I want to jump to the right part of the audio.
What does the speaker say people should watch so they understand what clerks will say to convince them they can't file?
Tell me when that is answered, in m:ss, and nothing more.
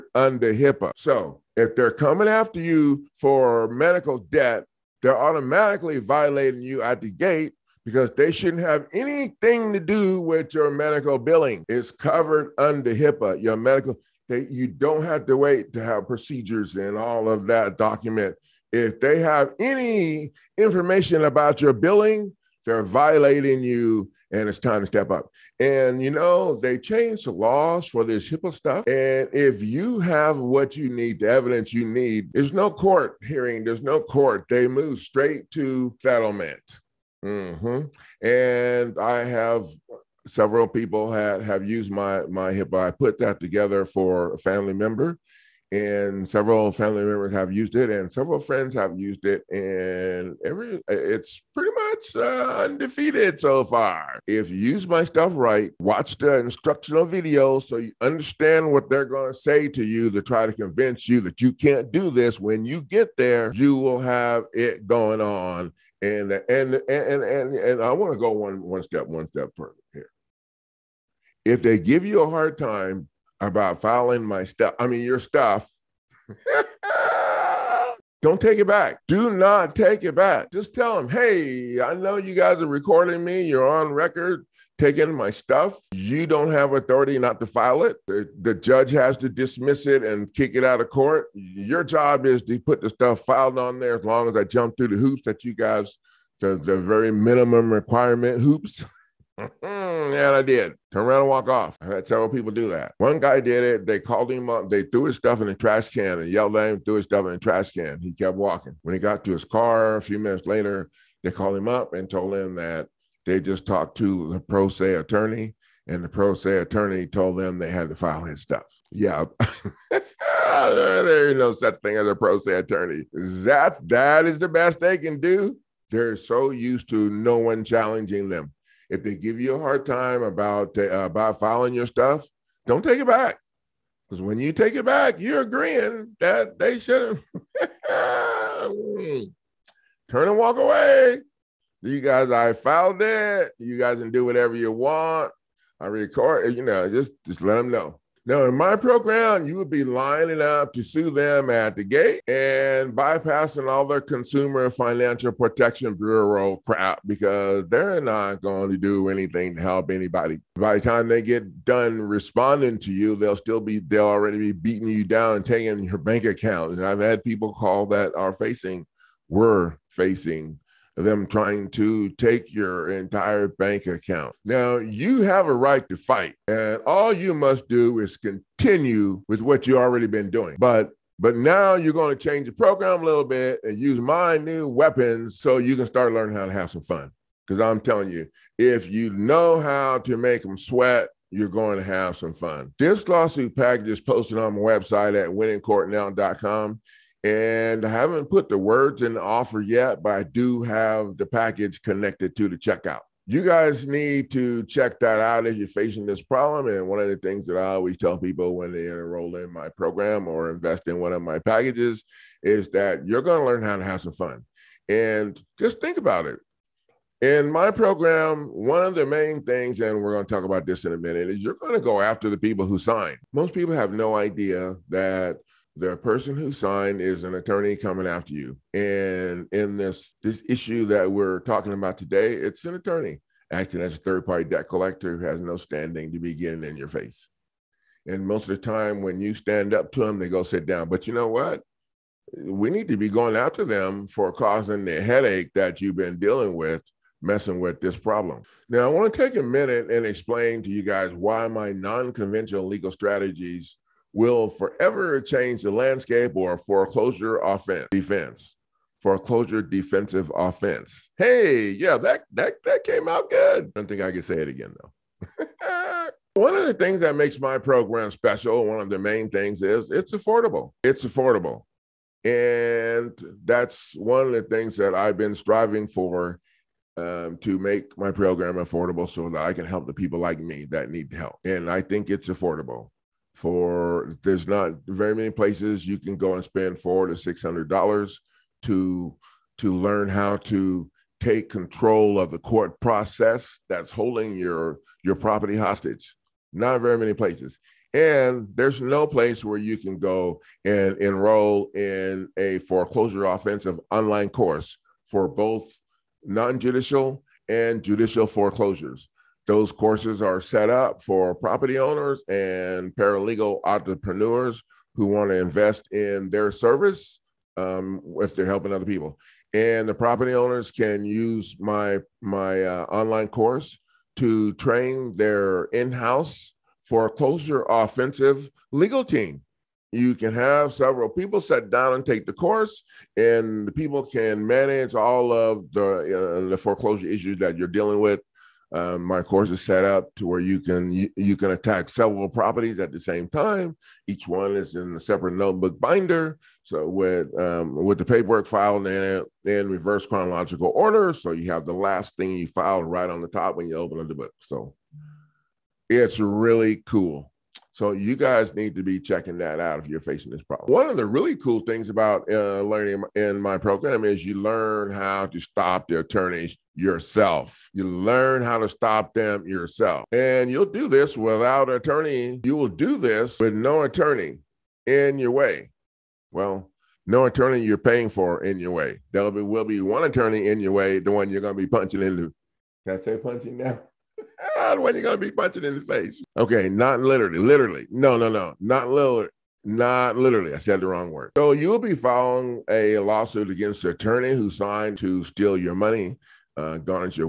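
0:56.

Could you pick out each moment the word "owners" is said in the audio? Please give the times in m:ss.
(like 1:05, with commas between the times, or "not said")
5:11, 5:20.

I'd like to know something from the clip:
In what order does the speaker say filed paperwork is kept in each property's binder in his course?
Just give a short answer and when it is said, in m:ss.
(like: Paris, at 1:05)
Reverse chronological order, at 5:49.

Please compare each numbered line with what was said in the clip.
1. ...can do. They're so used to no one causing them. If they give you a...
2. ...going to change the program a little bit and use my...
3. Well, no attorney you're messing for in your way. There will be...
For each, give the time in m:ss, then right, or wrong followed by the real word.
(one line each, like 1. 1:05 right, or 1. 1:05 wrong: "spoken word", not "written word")
1. 2:04 wrong: "challenging", not "causing"
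2. 3:01 right
3. 6:16 wrong: "paying", not "messing".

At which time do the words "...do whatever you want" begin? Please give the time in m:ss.
2:24.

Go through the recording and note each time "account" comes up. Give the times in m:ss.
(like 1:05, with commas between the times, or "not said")
2:46, 2:53.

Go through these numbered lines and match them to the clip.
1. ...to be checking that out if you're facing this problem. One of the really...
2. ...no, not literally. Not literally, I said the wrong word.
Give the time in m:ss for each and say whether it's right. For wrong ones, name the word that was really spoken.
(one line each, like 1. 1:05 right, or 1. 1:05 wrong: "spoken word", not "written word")
1. 5:58 right
2. 6:28 right.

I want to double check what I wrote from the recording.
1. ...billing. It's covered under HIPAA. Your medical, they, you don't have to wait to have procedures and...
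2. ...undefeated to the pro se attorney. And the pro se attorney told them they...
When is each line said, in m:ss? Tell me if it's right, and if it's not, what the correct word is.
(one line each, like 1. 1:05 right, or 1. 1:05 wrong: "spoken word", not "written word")
1. 0:11 right
2. 1:53 wrong: "talked", not "undefeated".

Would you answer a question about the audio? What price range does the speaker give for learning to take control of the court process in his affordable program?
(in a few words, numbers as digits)
$400 to $600.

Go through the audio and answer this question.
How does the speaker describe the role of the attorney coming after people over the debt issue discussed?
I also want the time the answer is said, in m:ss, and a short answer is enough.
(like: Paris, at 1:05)
Third party debt collector, at 3:53.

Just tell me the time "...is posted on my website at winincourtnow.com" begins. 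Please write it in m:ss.
3:13.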